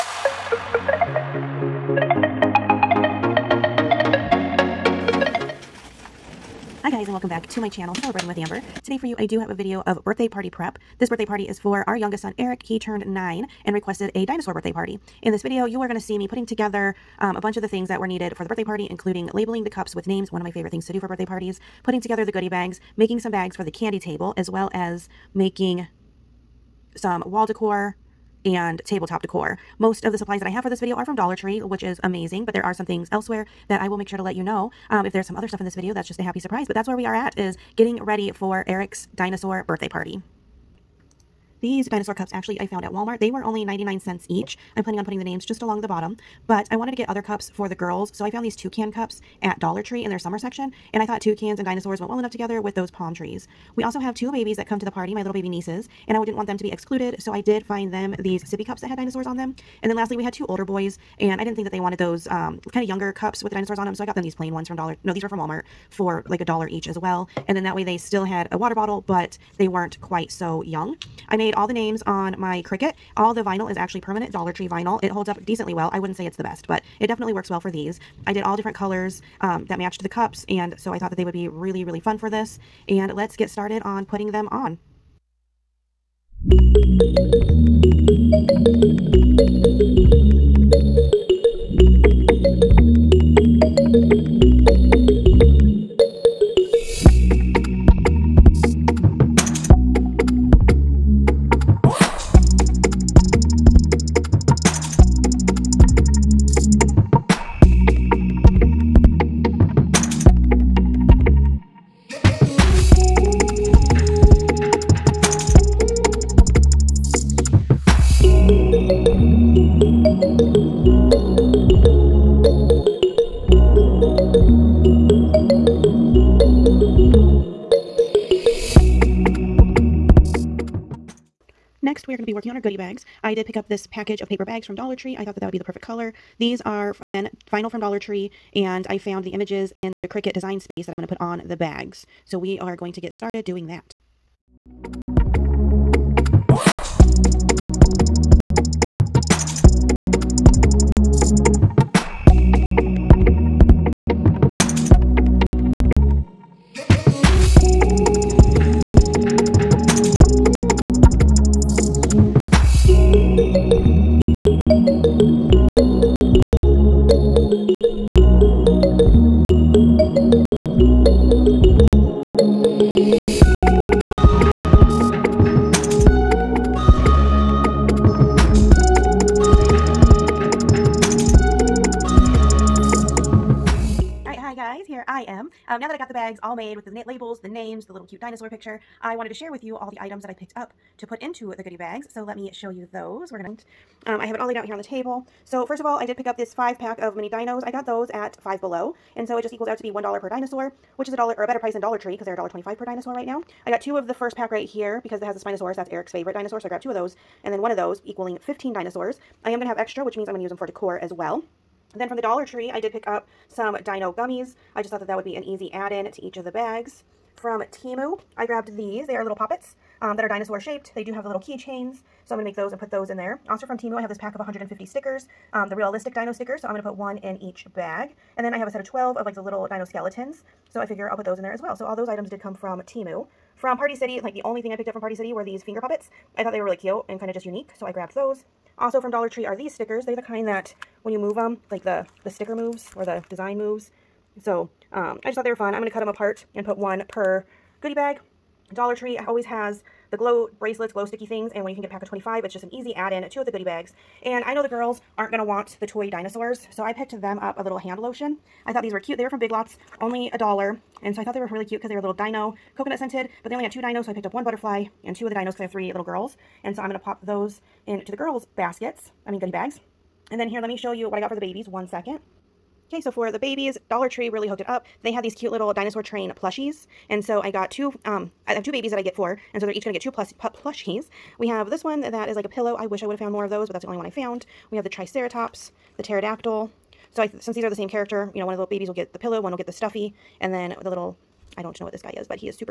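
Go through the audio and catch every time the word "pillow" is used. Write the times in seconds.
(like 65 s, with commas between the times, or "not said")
282 s, 289 s.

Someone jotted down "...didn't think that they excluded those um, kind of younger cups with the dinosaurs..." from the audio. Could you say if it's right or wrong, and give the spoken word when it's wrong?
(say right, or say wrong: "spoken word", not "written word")
wrong: "wanted", not "excluded".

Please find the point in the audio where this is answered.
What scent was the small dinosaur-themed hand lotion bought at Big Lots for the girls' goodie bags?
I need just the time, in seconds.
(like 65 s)
262 s.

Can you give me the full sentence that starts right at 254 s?
And I know the girls aren't going to want the toy dinosaurs, so I picked them up a little hand lotion.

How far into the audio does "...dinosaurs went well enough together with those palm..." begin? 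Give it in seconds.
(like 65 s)
51 s.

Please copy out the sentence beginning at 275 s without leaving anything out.
They had these cute little dinosaur train plushies.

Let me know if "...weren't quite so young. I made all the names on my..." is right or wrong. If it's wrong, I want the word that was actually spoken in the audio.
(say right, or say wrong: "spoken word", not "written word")
right.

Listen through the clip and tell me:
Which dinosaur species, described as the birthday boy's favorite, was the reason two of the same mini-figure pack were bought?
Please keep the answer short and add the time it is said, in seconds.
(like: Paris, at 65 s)
Spinosaurus, at 205 s.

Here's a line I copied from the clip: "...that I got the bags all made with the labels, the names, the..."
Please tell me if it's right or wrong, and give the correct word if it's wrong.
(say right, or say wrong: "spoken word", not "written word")
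right.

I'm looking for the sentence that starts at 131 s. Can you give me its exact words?
next we are going to be working on our goodie bags.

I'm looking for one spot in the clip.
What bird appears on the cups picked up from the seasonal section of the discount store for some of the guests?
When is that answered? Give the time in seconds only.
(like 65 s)
48 s.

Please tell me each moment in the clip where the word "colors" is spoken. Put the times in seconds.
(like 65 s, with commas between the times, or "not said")
78 s, 135 s.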